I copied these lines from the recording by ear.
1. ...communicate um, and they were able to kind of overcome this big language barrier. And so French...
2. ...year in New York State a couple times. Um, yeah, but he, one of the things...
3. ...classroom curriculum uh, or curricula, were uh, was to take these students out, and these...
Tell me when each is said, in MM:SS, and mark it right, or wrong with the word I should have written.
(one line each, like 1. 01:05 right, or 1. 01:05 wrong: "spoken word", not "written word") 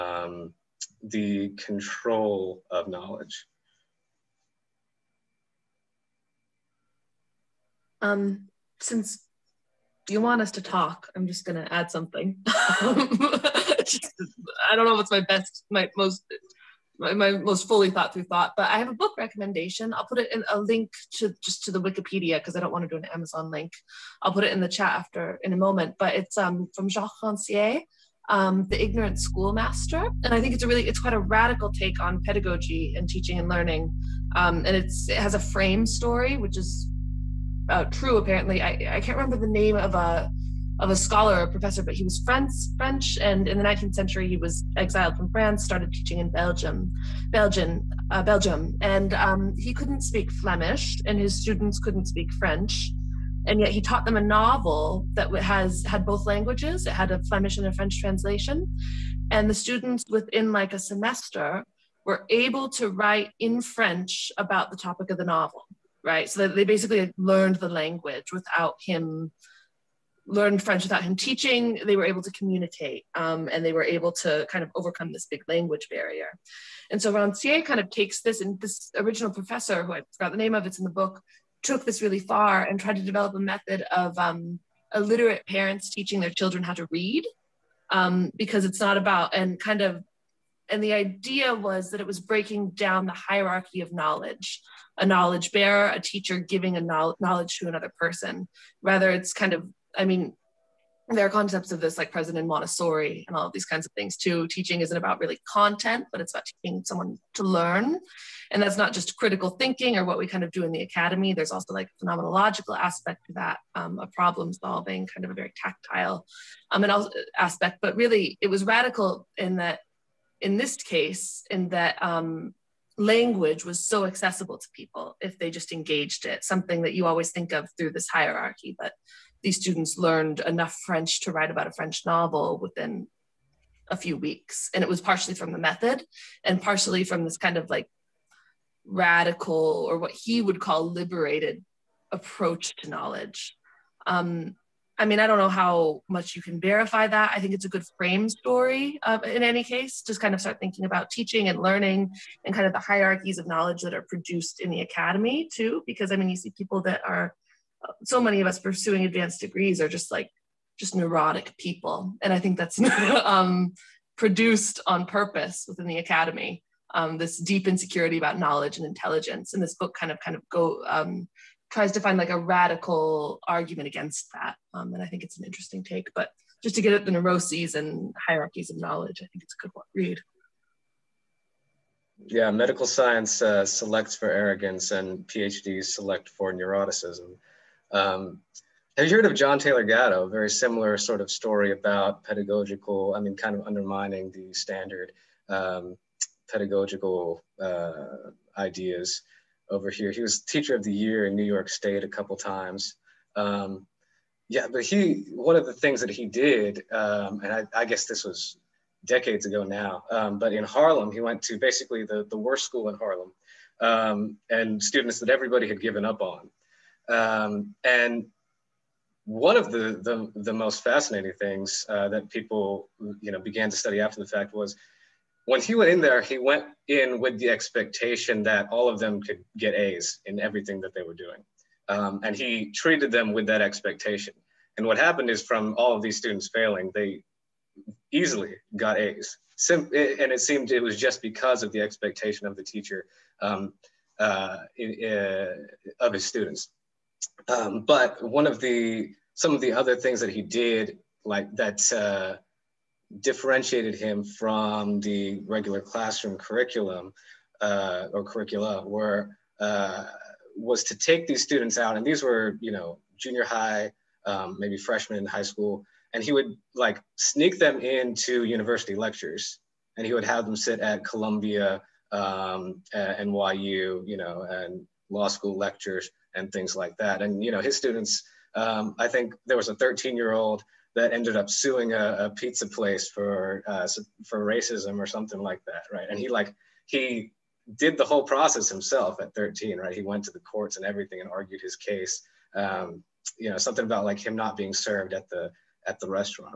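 1. 01:12 wrong: "Rancière", not "French"
2. 03:20 right
3. 04:15 right.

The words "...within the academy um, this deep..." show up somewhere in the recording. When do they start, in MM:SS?
02:45.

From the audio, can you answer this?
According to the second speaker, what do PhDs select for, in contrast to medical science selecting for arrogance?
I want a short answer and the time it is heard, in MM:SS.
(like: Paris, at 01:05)
Neuroticism, at 03:06.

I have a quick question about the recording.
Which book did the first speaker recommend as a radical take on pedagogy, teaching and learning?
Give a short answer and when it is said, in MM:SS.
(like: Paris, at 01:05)
The Ignorant Schoolmaster, at 00:28.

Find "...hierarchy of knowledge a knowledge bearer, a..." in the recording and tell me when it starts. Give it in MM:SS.
01:33.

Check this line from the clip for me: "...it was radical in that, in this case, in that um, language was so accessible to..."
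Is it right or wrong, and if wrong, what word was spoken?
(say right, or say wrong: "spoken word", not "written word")
right.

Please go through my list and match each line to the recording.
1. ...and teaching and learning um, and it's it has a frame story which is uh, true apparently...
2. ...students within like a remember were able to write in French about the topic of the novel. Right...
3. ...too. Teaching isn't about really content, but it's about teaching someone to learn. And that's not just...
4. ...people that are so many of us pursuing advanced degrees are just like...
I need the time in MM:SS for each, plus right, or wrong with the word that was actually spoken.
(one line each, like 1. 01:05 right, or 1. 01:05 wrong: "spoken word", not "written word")
1. 00:32 right
2. 00:59 wrong: "semester", not "remember"
3. 01:44 right
4. 02:36 right.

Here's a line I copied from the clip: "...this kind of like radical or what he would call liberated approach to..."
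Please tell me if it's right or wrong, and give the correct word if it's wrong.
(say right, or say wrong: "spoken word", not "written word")
right.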